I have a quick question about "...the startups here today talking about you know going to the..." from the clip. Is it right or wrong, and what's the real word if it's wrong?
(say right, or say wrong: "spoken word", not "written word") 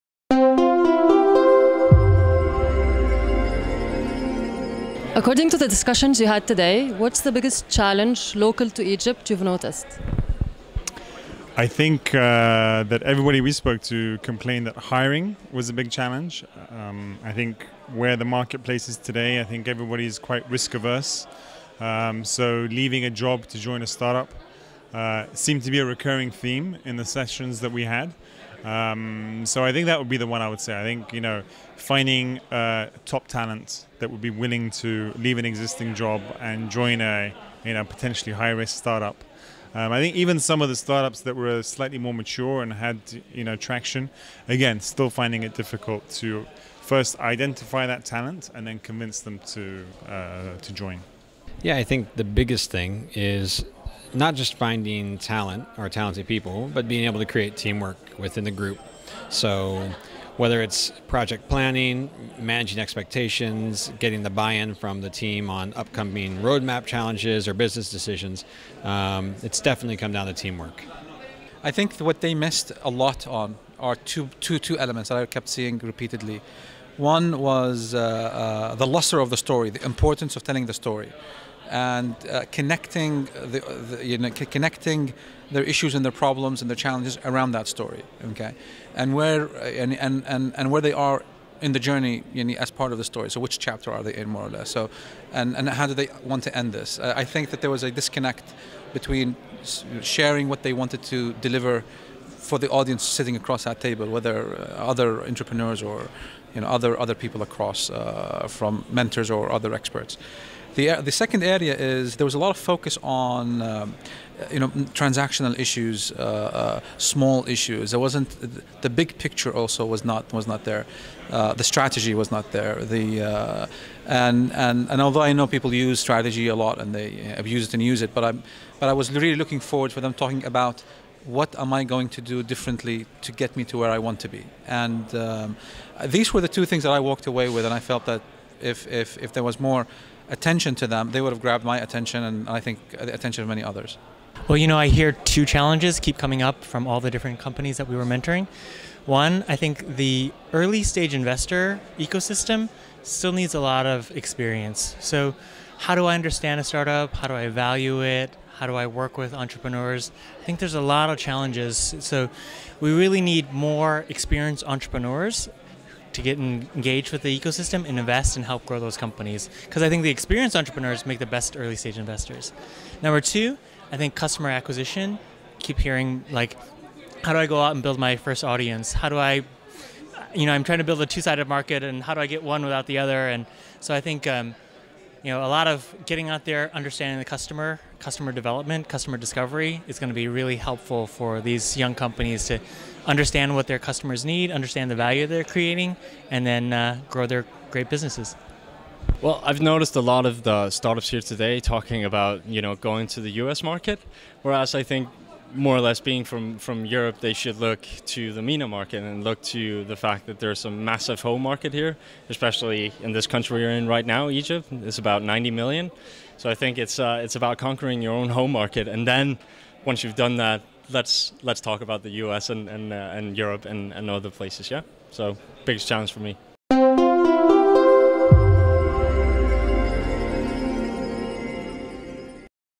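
right.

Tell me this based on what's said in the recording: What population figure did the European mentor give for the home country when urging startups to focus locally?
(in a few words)
90 million.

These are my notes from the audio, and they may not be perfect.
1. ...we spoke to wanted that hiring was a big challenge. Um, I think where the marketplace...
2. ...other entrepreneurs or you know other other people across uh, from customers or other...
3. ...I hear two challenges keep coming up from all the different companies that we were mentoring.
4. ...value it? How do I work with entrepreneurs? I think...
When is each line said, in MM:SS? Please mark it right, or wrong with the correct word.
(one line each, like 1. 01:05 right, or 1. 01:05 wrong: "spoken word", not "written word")
1. 00:13 wrong: "complained", not "wanted"
2. 01:44 wrong: "mentors", not "customers"
3. 02:24 right
4. 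02:37 right.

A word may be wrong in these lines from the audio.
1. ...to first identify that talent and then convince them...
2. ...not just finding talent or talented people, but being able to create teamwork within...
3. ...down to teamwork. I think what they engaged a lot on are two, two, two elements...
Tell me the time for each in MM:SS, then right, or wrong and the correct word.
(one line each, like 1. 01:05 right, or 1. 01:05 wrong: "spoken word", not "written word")
1. 00:46 right
2. 00:54 right
3. 01:10 wrong: "missed", not "engaged".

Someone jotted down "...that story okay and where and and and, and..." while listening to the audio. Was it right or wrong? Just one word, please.
right.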